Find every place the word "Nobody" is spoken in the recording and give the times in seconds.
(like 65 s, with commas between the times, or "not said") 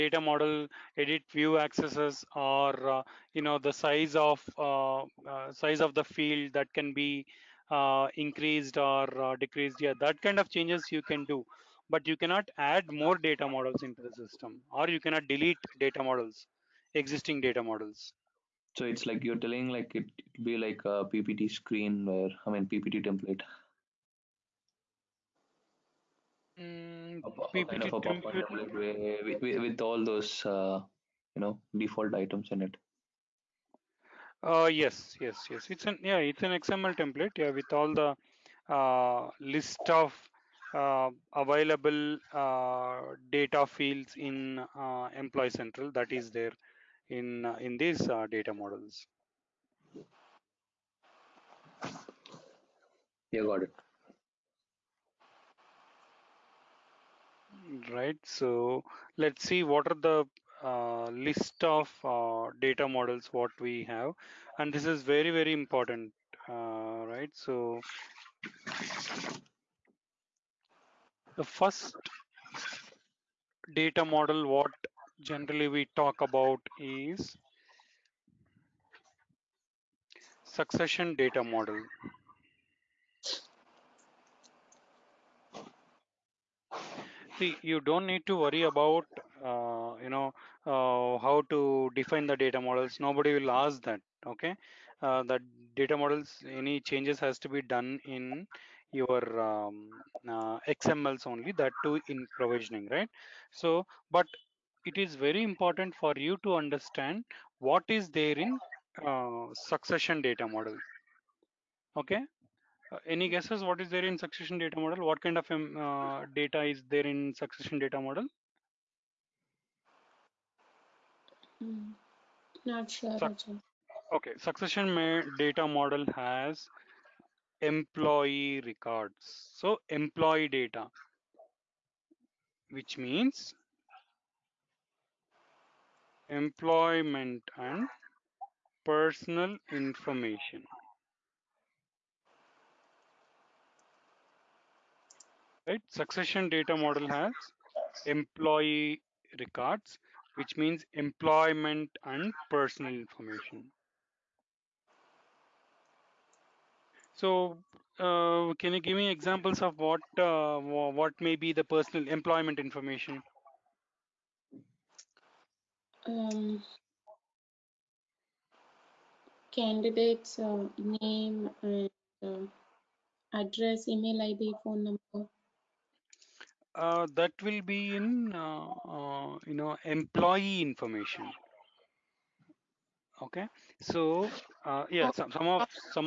93 s.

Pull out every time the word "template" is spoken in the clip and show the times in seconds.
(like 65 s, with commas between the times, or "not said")
23 s, 36 s.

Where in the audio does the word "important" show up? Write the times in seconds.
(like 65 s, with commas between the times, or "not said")
65 s, 105 s.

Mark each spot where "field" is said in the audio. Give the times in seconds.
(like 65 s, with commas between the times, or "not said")
6 s, 43 s.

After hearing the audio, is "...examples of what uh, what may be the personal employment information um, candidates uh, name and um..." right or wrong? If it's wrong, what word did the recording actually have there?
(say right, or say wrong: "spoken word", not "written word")
right.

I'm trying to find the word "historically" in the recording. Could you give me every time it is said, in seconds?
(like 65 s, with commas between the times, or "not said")
not said.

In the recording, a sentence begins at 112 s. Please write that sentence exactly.
Uh, any guesses what is there in succession data model?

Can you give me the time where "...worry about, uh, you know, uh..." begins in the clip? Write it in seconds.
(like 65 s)
88 s.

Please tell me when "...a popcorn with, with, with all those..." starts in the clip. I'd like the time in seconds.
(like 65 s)
27 s.